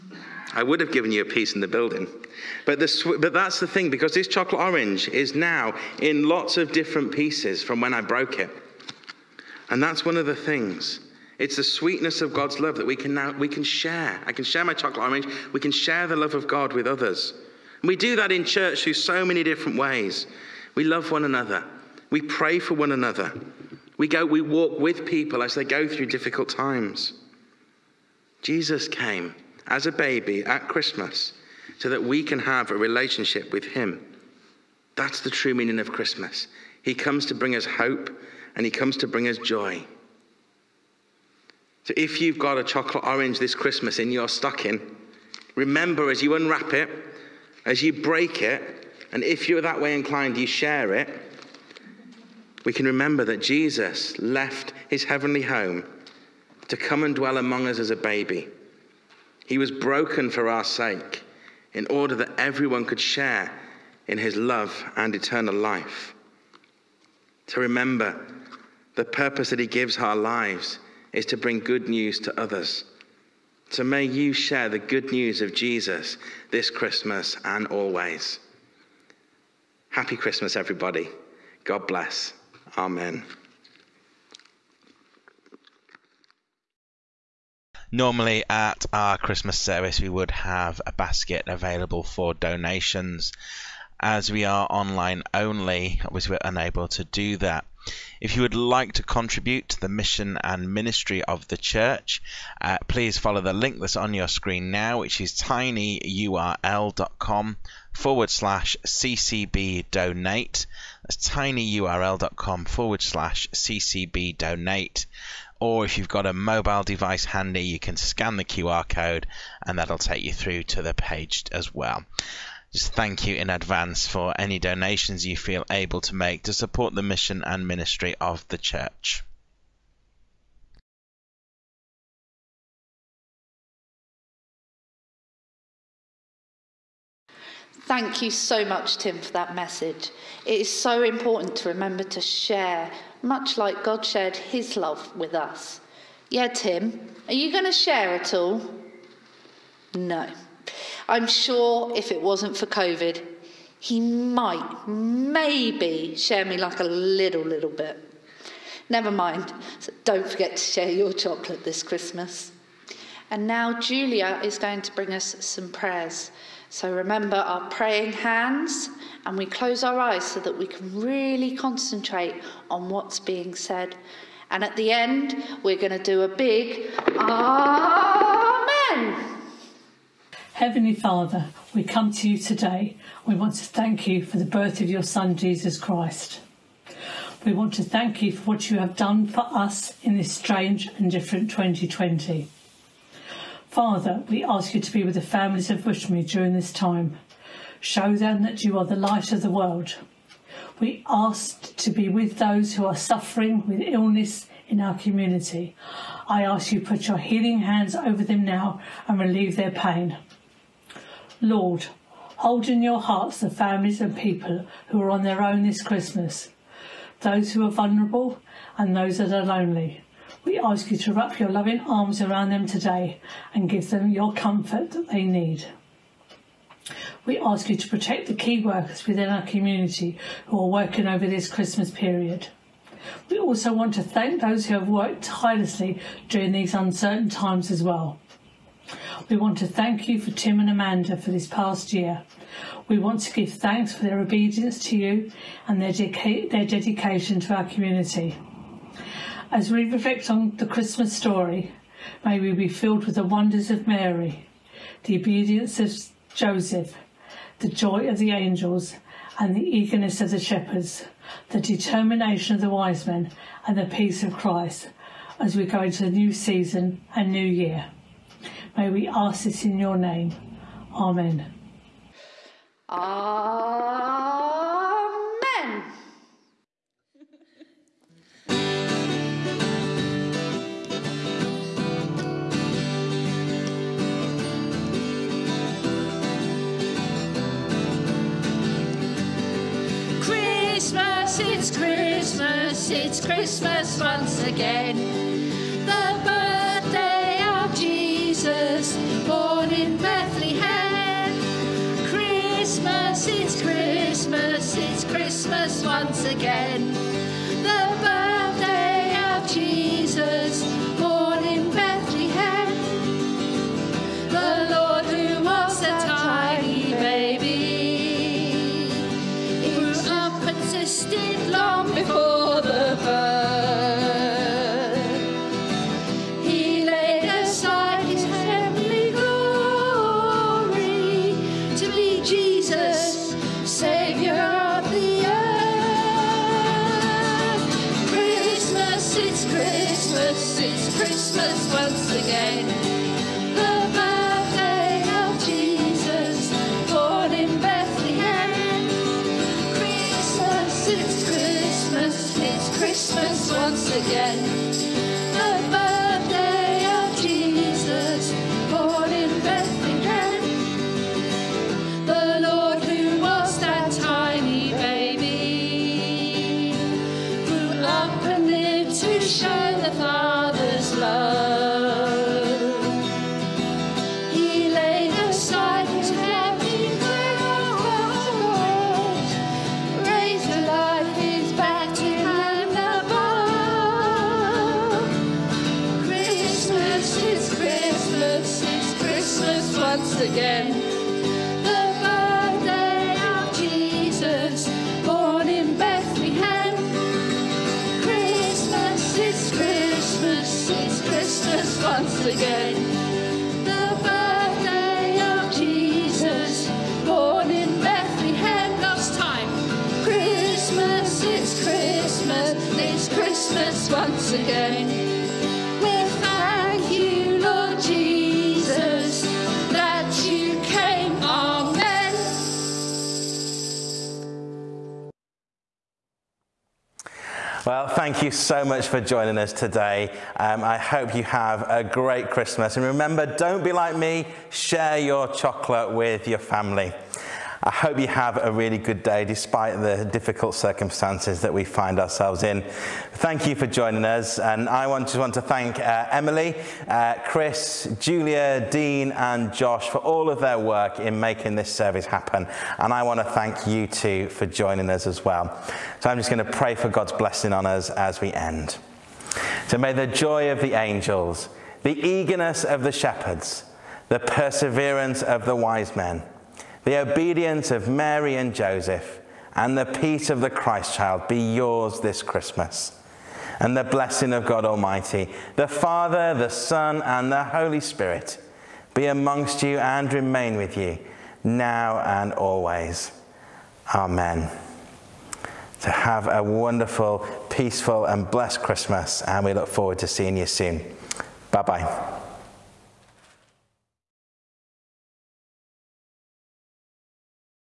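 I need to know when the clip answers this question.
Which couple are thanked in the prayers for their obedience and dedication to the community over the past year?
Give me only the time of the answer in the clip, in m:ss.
4:00.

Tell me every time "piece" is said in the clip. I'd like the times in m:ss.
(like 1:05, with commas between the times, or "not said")
0:01, 0:07.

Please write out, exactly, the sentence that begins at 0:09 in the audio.
And that's one of the things.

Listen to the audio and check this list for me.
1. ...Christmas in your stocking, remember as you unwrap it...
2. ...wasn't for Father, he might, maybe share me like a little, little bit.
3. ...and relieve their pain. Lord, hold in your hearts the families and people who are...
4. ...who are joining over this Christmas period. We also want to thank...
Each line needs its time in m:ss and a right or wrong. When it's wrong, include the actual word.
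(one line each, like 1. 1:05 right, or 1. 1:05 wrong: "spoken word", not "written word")
1. 0:43 right
2. 2:32 wrong: "COVID", not "Father"
3. 3:29 right
4. 3:50 wrong: "working", not "joining".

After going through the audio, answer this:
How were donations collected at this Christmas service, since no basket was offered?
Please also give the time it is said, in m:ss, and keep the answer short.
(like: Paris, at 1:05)
Online only, at 1:34.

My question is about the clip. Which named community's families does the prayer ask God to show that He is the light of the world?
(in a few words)
Bushmead.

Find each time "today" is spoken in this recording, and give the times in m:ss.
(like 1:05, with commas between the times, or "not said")
3:02, 3:42, 7:09.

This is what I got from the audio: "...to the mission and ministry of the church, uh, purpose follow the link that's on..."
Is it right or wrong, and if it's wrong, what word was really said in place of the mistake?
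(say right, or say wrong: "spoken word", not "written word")
wrong: "please", not "purpose".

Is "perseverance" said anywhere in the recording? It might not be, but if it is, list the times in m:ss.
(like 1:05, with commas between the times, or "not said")
7:44.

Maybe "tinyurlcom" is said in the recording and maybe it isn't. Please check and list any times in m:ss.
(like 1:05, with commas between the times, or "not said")
1:45, 1:51.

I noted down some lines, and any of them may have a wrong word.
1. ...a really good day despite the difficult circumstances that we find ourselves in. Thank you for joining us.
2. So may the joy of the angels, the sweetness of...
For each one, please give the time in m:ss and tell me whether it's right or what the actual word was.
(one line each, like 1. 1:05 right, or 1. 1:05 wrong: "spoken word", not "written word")
1. 7:18 right
2. 7:39 wrong: "eagerness", not "sweetness".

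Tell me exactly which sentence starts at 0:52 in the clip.
We can remember that Jesus left his heavenly home to come and dwell among us as a baby.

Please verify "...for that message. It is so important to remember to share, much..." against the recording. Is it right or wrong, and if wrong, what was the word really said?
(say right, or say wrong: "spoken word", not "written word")
right.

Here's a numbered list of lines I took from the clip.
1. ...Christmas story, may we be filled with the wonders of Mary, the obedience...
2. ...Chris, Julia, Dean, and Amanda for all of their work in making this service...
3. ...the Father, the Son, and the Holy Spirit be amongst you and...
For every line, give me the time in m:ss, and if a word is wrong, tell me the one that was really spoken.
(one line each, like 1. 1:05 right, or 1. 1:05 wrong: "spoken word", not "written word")
1. 4:10 right
2. 7:27 wrong: "Josh", not "Amanda"
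3. 7:55 right.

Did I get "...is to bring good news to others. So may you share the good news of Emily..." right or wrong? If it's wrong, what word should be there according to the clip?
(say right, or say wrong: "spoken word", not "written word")
wrong: "Jesus", not "Emily".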